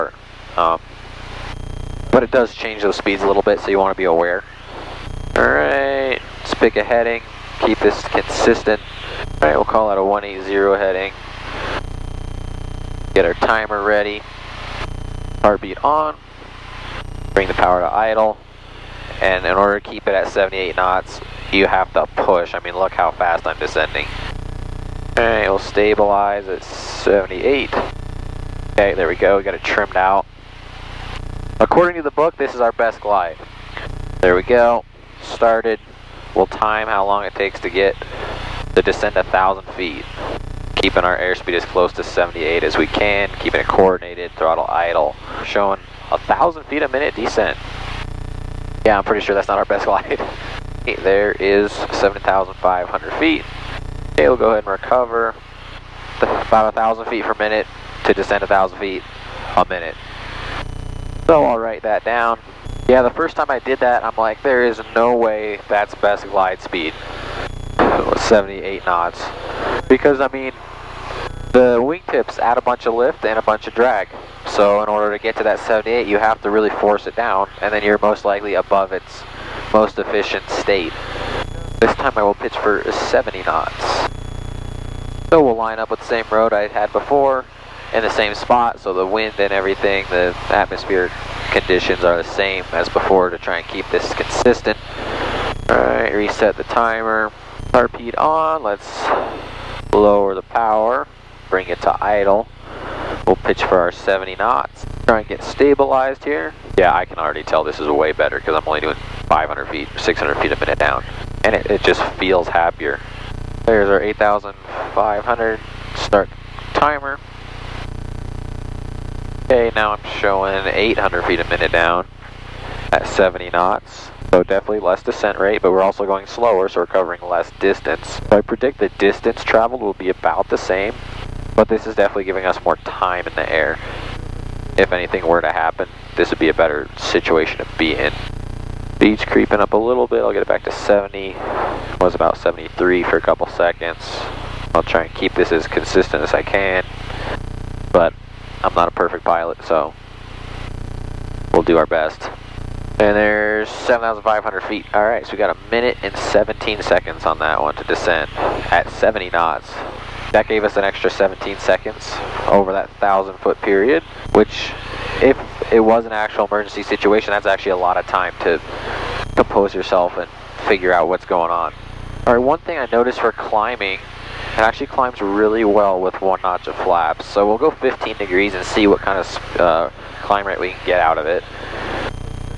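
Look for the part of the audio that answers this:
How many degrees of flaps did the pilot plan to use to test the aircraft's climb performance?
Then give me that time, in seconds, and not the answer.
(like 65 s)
177 s.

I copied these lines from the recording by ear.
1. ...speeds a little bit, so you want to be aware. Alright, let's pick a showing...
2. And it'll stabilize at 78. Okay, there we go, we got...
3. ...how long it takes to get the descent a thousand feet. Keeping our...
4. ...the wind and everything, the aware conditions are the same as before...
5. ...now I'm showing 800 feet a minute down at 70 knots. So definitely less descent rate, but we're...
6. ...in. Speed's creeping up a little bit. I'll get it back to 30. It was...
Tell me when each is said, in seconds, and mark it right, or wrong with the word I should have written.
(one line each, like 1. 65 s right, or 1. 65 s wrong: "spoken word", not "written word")
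1. 2 s wrong: "heading", not "showing"
2. 25 s right
3. 36 s right
4. 88 s wrong: "atmosphere", not "aware"
5. 119 s right
6. 137 s wrong: "70", not "30".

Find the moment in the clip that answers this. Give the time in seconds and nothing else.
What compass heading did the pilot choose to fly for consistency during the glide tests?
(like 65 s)
10 s.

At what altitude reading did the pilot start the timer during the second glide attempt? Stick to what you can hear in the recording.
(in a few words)
8,500 feet.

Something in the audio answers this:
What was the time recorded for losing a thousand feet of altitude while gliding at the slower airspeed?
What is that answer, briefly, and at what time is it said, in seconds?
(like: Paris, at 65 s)
1 minute 17 seconds, at 155 s.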